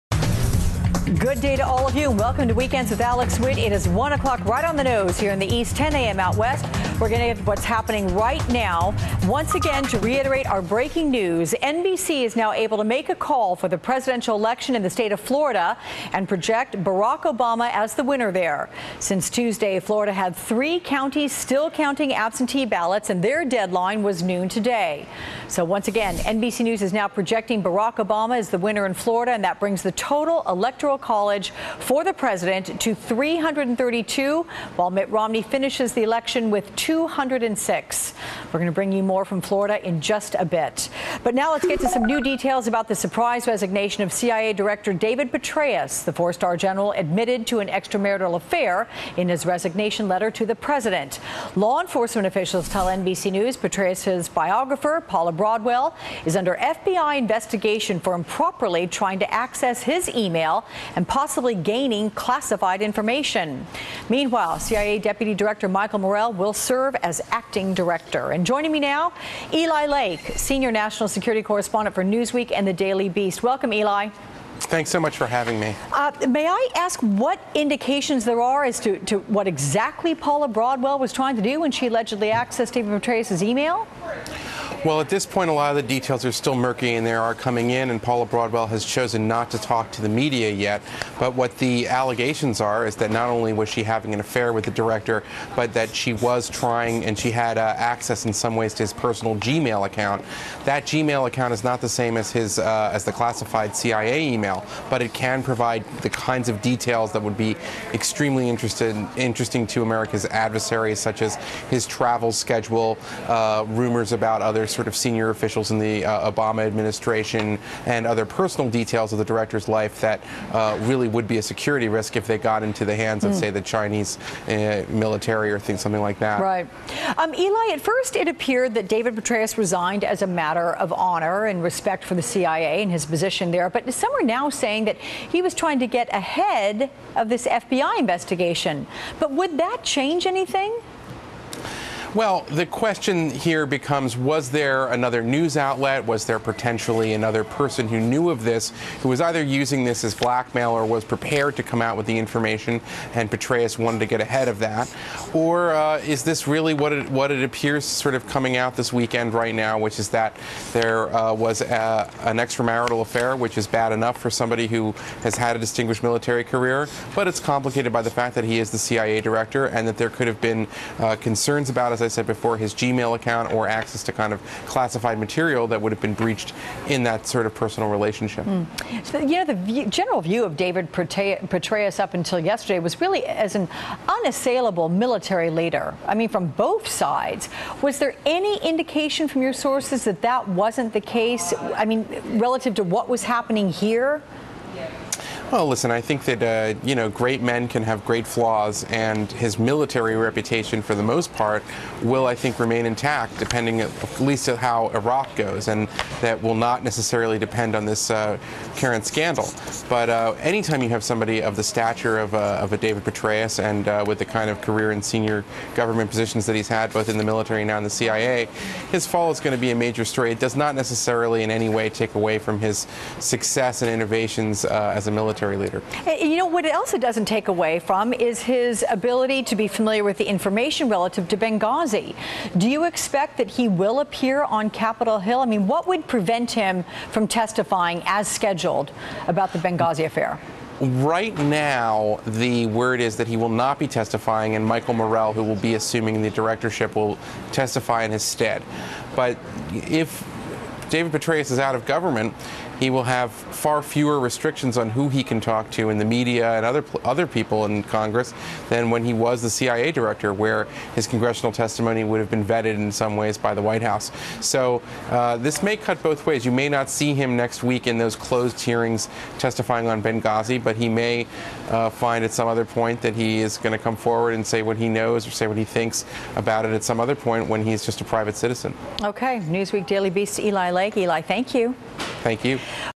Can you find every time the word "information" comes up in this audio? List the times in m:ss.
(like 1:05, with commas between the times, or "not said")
1:02, 2:32, 3:50.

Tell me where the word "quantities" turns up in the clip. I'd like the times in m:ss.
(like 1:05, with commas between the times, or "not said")
not said.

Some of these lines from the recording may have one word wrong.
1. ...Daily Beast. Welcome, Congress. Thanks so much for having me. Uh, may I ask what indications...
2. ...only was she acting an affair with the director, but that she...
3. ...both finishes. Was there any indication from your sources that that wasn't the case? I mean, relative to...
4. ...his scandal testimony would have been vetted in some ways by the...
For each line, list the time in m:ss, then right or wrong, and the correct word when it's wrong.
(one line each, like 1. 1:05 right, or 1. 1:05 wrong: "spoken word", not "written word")
1. 1:12 wrong: "Eli", not "Congress"
2. 1:33 wrong: "having", not "acting"
3. 3:06 wrong: "sides", not "finishes"
4. 4:20 wrong: "congressional", not "scandal".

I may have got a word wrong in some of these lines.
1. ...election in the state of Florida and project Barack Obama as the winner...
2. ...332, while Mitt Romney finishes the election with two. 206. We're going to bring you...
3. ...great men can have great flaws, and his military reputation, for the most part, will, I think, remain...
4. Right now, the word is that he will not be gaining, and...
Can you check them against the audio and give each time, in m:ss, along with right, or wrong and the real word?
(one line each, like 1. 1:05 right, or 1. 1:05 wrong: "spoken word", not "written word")
1. 0:14 right
2. 0:32 right
3. 3:17 right
4. 4:00 wrong: "testifying", not "gaining".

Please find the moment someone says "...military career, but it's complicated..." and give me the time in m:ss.
2:46.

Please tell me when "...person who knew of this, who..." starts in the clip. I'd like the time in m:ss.
2:27.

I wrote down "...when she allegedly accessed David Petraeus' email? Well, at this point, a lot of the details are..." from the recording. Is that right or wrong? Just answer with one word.
right.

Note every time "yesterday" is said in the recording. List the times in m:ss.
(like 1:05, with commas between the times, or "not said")
3:02.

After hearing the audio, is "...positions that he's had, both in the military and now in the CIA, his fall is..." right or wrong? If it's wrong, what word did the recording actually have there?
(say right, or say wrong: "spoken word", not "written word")
right.